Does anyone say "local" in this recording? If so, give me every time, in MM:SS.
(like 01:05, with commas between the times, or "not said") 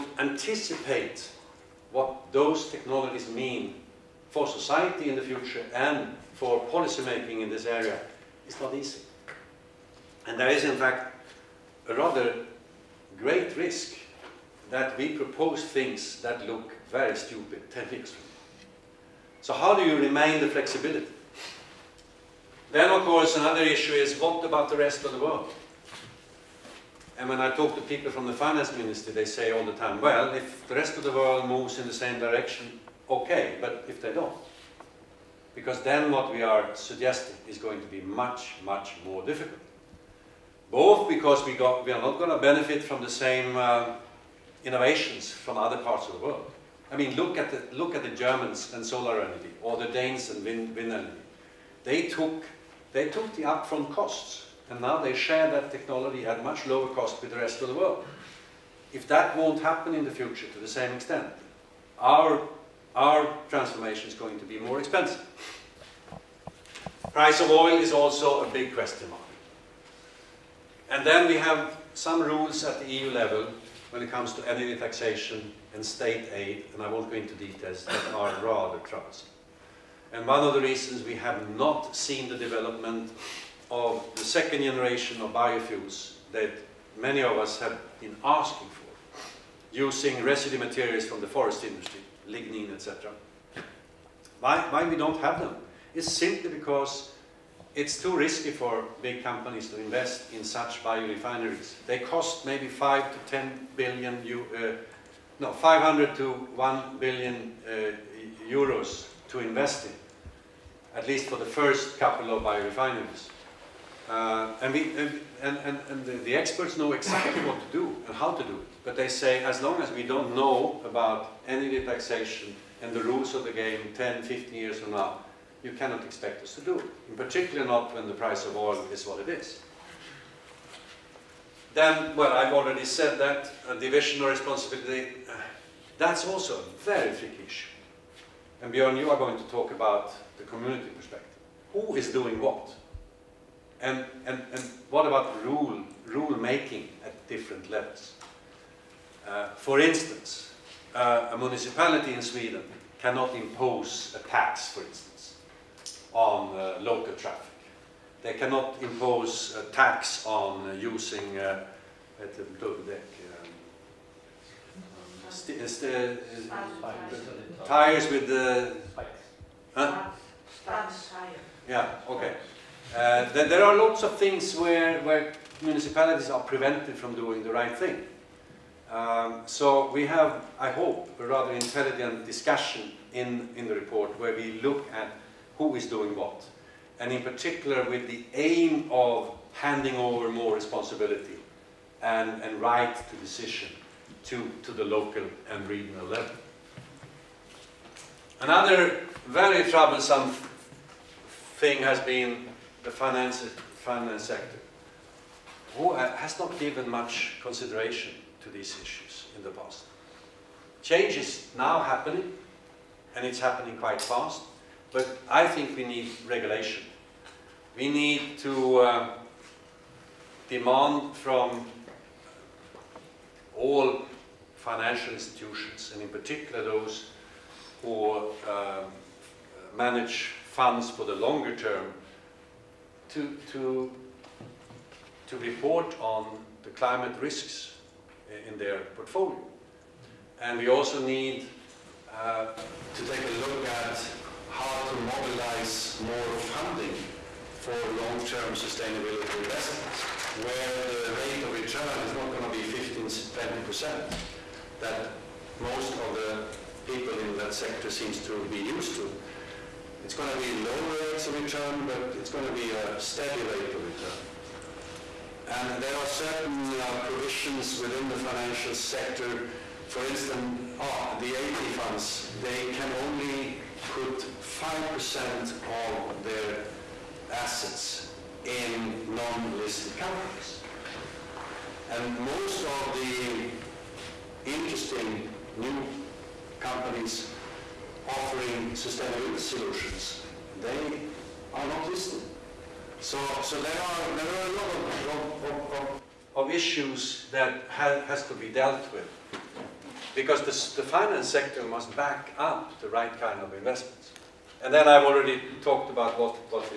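02:36, 03:14.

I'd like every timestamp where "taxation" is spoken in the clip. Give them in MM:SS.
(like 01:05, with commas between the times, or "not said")
01:14, 02:01.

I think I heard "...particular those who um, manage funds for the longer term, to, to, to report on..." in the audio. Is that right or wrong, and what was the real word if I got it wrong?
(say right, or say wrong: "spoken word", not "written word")
right.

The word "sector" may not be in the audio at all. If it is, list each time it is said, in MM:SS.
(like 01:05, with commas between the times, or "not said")
03:24, 04:17, 04:28, 05:01.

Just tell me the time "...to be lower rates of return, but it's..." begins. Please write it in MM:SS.
04:20.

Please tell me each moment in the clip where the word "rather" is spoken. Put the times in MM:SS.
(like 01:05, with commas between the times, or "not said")
00:11, 01:18, 03:01.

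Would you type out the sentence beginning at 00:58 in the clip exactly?
If that won't happen in the future to the same extent, our, our transformation is going to be more expensive.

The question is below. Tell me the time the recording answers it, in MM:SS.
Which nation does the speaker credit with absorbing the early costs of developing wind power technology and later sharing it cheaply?
00:49.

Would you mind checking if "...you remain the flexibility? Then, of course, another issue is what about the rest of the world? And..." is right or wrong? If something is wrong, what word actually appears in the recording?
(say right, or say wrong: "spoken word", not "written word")
right.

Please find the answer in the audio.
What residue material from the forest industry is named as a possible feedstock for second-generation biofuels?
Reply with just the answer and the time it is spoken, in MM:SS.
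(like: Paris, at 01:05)
lignin, at 01:32.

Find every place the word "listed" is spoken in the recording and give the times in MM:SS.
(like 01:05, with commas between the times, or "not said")
04:39, 04:51.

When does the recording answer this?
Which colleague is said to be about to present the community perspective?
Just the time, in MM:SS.
02:18.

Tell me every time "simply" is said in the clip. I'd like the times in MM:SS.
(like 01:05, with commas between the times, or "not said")
01:36.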